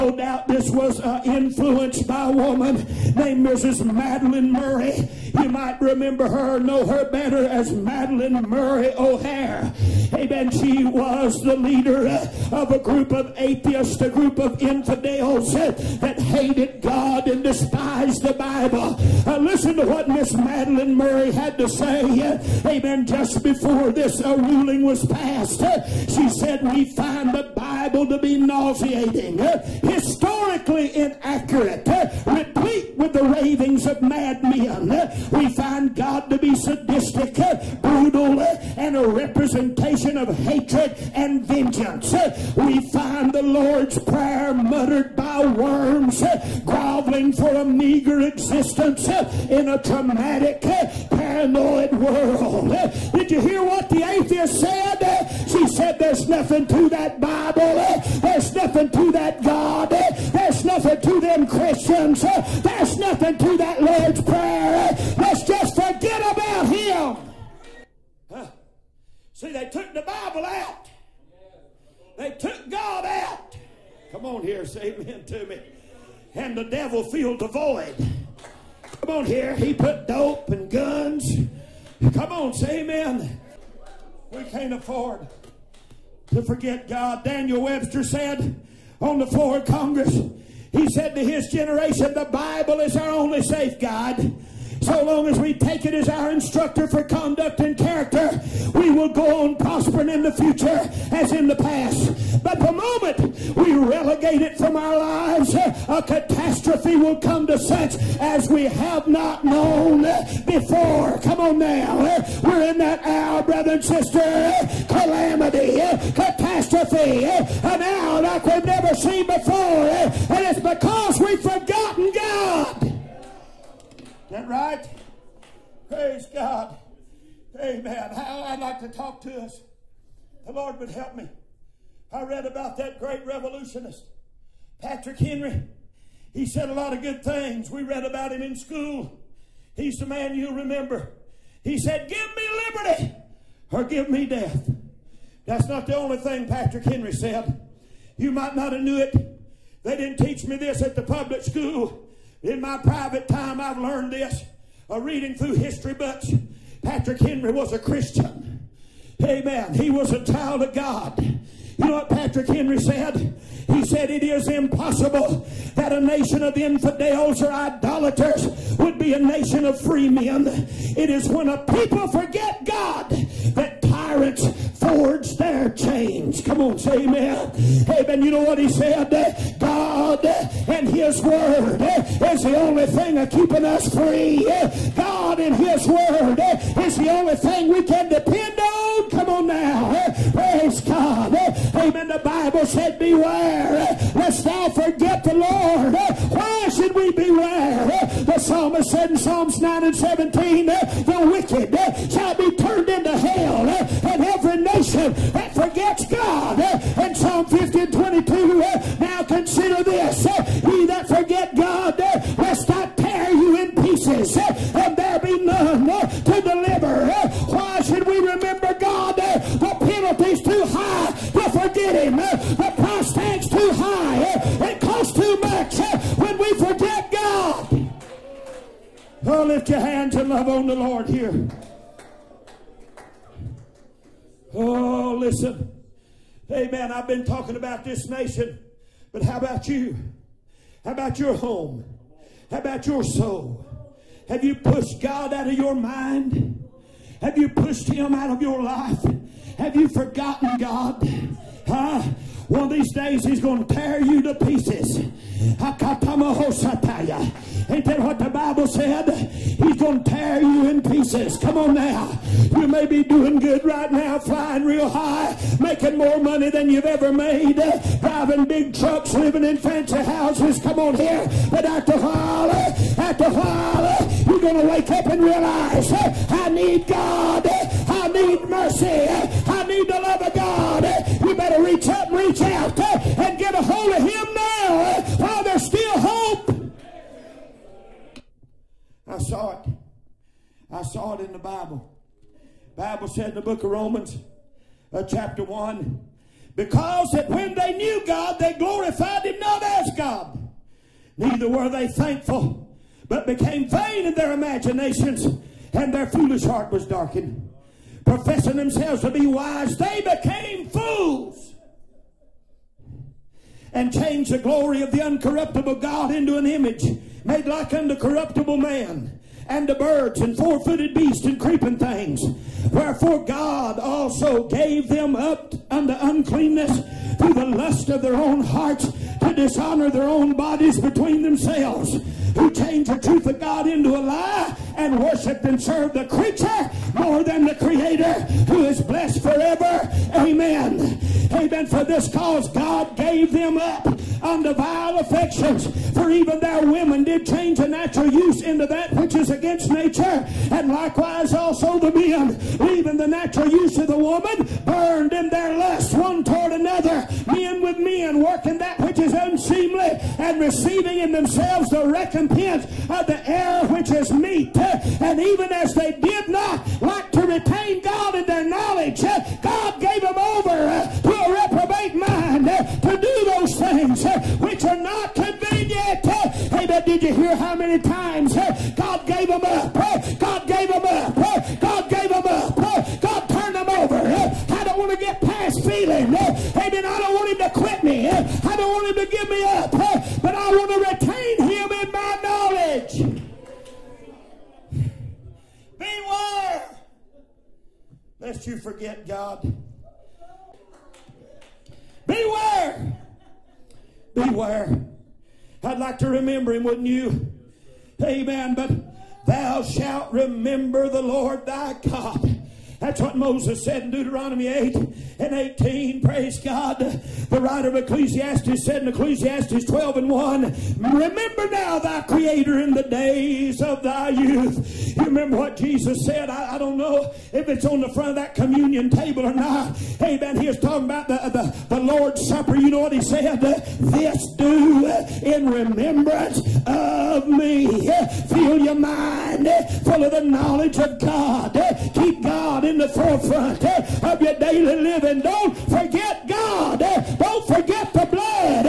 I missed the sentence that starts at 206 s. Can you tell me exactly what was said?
And Psalm 50 and 22, now consider this.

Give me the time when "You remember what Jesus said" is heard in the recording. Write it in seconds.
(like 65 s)
424 s.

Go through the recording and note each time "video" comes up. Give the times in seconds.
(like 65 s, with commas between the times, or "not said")
not said.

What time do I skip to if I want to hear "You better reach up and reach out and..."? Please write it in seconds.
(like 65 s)
281 s.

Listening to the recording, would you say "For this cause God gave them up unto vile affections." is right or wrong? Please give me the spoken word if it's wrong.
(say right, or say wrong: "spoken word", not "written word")
right.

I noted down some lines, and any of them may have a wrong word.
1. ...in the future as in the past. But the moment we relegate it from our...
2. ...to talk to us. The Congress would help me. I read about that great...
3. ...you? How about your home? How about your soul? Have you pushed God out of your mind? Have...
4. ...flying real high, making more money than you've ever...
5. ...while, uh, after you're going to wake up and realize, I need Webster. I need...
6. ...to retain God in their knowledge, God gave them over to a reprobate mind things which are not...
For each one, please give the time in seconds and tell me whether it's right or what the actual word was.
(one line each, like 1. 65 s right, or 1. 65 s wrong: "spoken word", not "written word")
1. 100 s right
2. 128 s wrong: "Lord", not "Congress"
3. 239 s right
4. 264 s right
5. 271 s wrong: "God", not "Webster"
6. 367 s right.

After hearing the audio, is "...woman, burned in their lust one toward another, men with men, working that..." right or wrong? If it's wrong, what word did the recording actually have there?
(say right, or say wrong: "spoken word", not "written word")
right.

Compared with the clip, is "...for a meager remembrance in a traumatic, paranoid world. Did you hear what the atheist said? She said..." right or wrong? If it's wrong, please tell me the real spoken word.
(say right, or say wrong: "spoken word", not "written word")
wrong: "existence", not "remembrance".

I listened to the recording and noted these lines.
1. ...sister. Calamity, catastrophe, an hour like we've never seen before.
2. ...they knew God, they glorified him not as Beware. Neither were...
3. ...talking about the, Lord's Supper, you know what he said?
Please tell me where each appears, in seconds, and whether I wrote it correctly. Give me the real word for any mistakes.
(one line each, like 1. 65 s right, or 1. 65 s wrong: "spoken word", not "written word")
1. 113 s right
2. 297 s wrong: "God", not "Beware"
3. 430 s right.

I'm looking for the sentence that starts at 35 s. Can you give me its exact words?
We find God to be sadistic, brutal, and a representation of hatred and vengeance.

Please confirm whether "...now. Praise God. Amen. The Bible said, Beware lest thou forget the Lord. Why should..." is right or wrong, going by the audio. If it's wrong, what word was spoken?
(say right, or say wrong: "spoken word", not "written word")
right.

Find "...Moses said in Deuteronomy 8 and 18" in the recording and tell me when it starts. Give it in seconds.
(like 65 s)
413 s.